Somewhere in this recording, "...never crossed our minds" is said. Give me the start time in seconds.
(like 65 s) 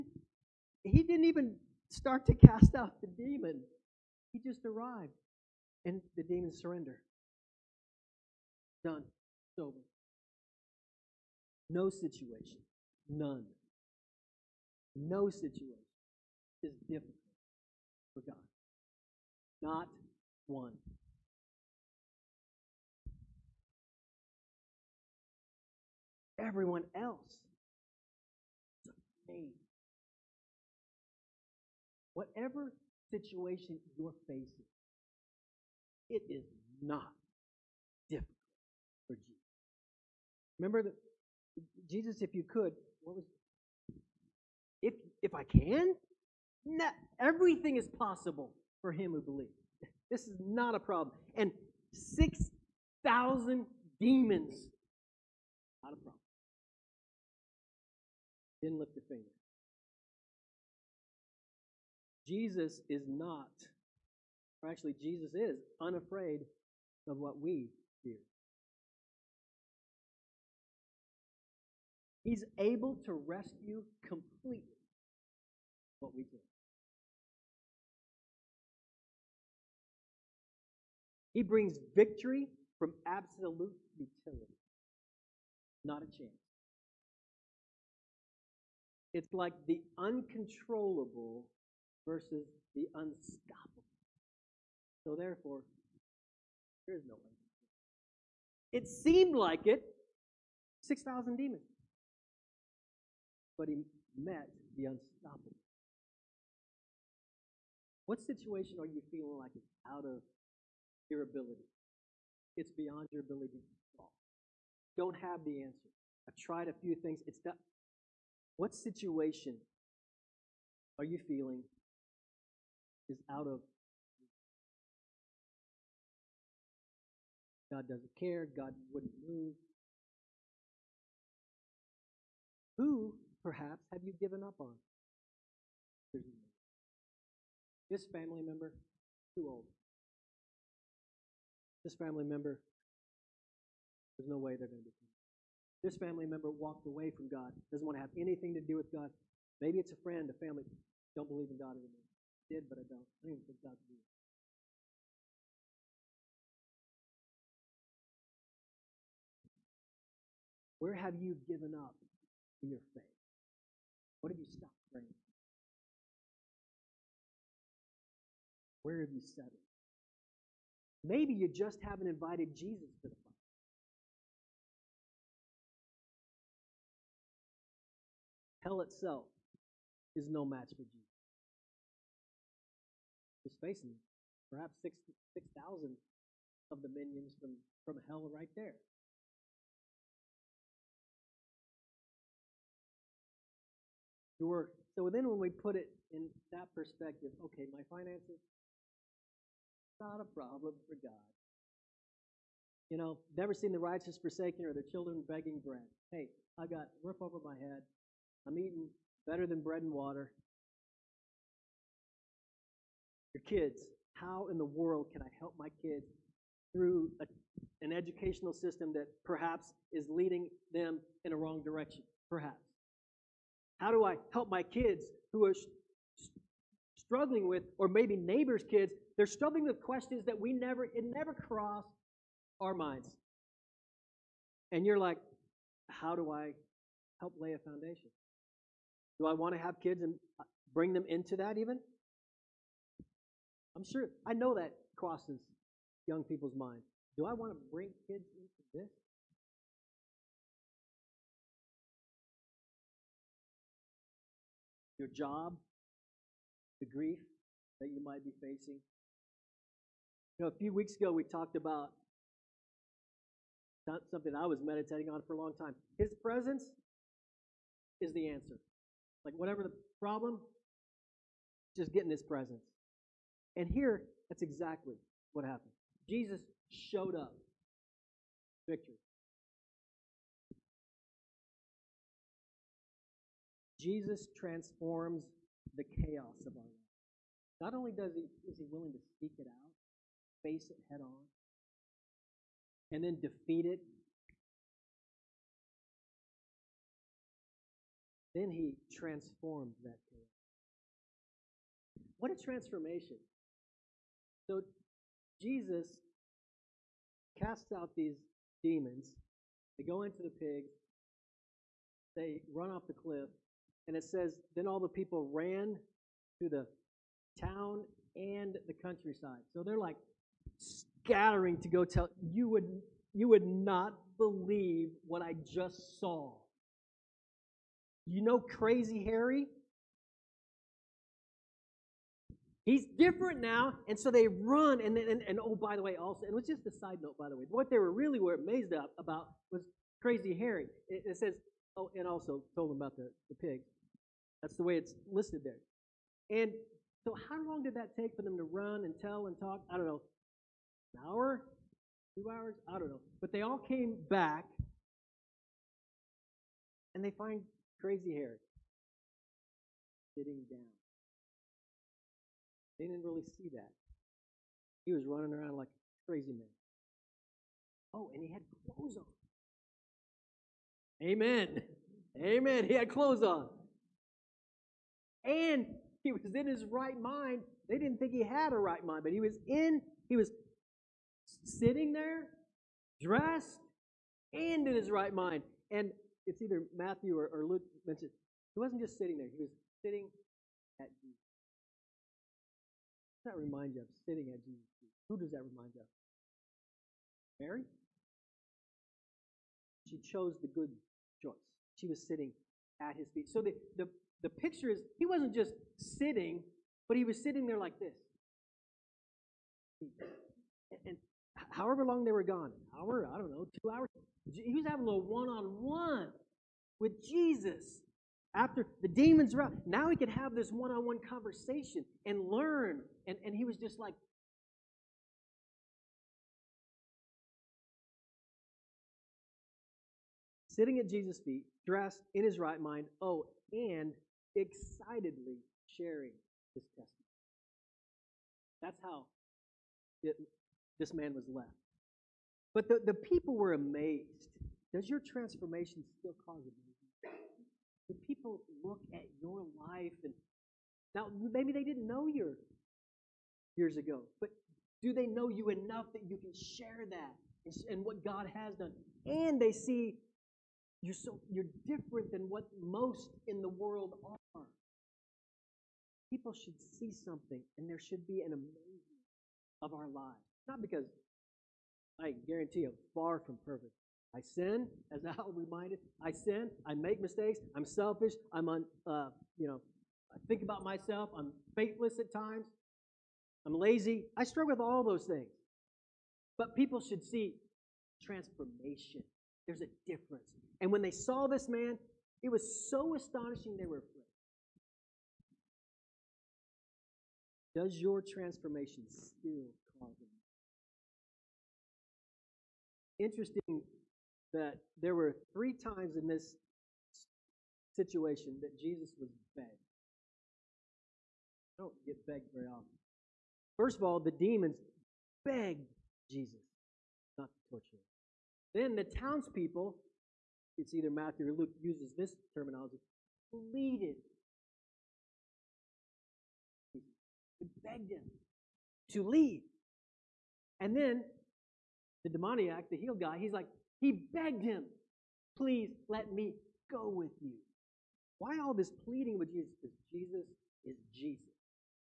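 231 s.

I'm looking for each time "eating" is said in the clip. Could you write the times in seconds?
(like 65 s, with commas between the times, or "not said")
208 s.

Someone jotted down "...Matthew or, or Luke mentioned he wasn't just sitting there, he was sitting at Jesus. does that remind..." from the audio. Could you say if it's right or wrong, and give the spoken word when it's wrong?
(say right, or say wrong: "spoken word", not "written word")
right.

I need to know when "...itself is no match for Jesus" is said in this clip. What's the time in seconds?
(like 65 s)
178 s.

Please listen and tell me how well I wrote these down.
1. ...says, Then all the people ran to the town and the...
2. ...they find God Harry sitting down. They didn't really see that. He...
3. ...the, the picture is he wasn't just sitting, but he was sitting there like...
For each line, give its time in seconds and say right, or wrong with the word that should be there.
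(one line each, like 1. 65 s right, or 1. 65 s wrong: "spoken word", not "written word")
1. 314 s right
2. 357 s wrong: "Crazy", not "God"
3. 403 s right.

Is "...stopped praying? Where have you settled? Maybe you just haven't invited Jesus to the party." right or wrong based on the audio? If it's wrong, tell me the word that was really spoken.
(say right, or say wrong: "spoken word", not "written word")
right.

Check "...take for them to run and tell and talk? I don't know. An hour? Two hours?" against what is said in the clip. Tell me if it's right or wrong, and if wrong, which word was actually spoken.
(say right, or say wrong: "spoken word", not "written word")
right.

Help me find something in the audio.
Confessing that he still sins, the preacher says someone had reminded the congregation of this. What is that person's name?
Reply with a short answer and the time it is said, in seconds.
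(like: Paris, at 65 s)
Al, at 475 s.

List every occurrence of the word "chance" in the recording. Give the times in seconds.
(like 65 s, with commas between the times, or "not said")
86 s.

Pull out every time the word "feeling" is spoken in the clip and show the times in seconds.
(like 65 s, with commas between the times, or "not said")
109 s, 121 s.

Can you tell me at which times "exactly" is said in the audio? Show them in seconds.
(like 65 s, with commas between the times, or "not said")
274 s.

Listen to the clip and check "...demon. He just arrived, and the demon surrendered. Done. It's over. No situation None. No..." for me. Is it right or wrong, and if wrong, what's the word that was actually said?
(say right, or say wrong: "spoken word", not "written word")
right.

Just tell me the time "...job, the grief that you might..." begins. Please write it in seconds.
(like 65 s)
255 s.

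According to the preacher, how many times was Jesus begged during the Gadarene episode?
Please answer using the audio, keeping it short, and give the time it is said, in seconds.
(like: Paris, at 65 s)
3, at 505 s.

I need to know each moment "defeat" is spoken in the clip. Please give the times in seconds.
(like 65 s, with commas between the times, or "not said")
293 s.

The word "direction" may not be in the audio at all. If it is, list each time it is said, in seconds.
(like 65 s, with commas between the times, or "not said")
221 s.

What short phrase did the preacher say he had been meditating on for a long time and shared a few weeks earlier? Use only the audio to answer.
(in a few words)
His presence is the answer.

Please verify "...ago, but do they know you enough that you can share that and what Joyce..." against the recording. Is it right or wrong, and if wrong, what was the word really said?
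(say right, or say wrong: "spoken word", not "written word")
wrong: "God", not "Joyce".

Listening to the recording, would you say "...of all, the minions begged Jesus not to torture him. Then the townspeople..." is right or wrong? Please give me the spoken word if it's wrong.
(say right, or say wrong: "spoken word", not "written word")
wrong: "demons", not "minions".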